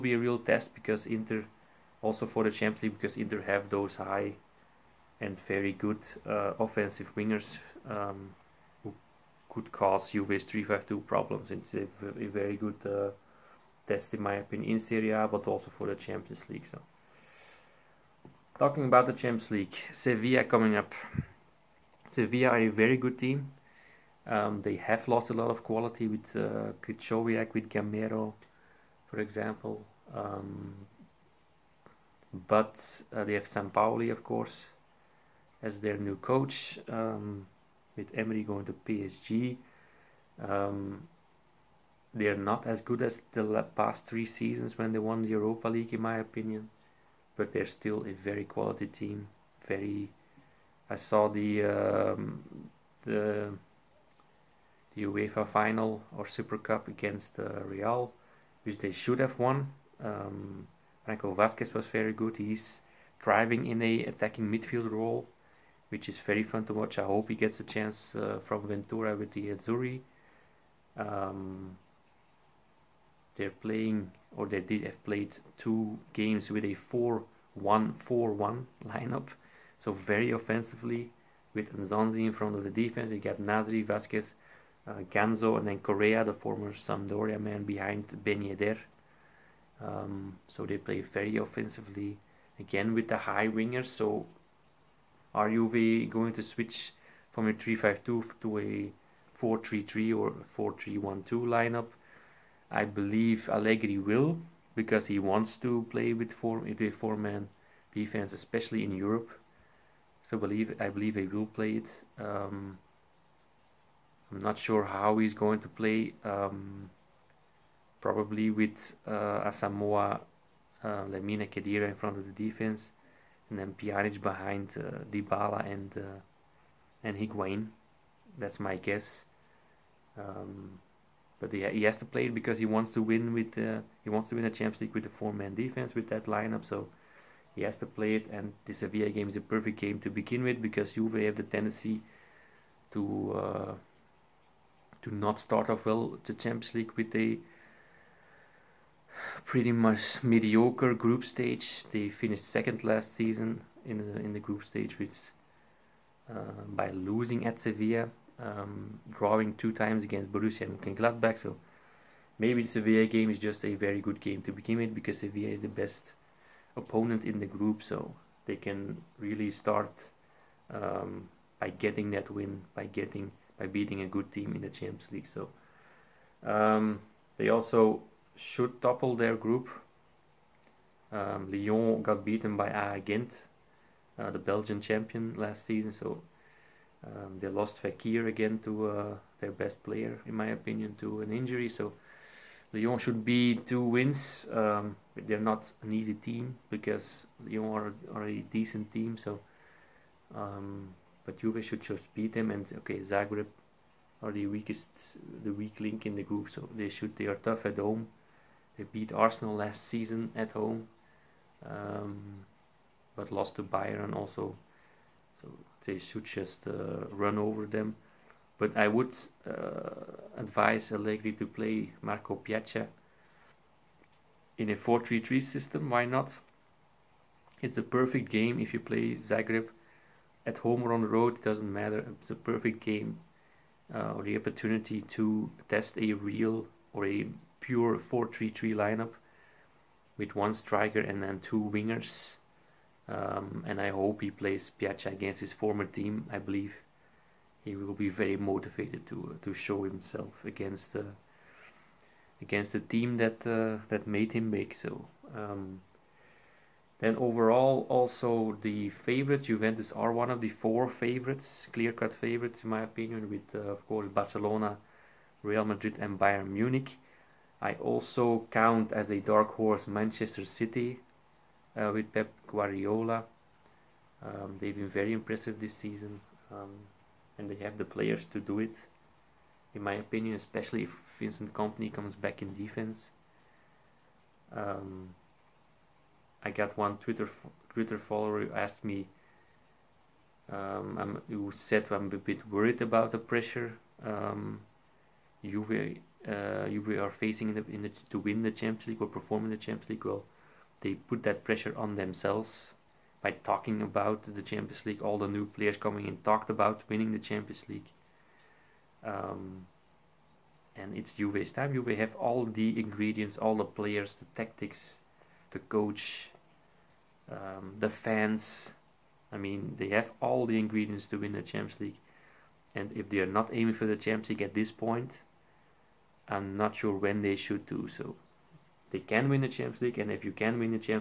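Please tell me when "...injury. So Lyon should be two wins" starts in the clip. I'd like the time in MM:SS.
03:11.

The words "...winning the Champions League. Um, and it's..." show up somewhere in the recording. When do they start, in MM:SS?
05:06.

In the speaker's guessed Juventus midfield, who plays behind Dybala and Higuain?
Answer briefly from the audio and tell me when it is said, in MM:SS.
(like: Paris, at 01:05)
Pjanic, at 02:03.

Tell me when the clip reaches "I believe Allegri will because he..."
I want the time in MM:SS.
01:42.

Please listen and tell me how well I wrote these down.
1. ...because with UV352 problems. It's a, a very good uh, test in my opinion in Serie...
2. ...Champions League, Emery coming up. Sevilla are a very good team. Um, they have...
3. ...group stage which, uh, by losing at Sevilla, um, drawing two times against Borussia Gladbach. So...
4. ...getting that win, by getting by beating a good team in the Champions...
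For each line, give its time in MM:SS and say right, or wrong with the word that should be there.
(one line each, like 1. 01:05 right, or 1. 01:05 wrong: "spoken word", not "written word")
1. 00:09 right
2. 00:19 wrong: "Sevilla", not "Emery"
3. 02:34 right
4. 02:51 right.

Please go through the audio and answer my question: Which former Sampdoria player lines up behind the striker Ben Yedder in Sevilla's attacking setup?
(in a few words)
Correa.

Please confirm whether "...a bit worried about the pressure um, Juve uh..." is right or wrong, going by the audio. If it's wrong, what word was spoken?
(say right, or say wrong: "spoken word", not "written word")
right.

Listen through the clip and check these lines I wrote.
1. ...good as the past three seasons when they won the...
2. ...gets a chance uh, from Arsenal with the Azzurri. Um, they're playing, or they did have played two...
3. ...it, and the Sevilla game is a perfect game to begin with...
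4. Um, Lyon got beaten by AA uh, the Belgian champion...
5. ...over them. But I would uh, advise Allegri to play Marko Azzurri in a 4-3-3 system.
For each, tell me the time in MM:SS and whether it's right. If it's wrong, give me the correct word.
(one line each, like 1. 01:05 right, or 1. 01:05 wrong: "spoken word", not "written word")
1. 00:42 right
2. 01:07 wrong: "Ventura", not "Arsenal"
3. 02:18 right
4. 03:01 right
5. 03:37 wrong: "Pjaca", not "Azzurri".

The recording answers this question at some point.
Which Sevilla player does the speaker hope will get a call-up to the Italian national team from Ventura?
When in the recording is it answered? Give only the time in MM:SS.
01:01.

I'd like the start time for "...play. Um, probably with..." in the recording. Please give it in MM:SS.
01:55.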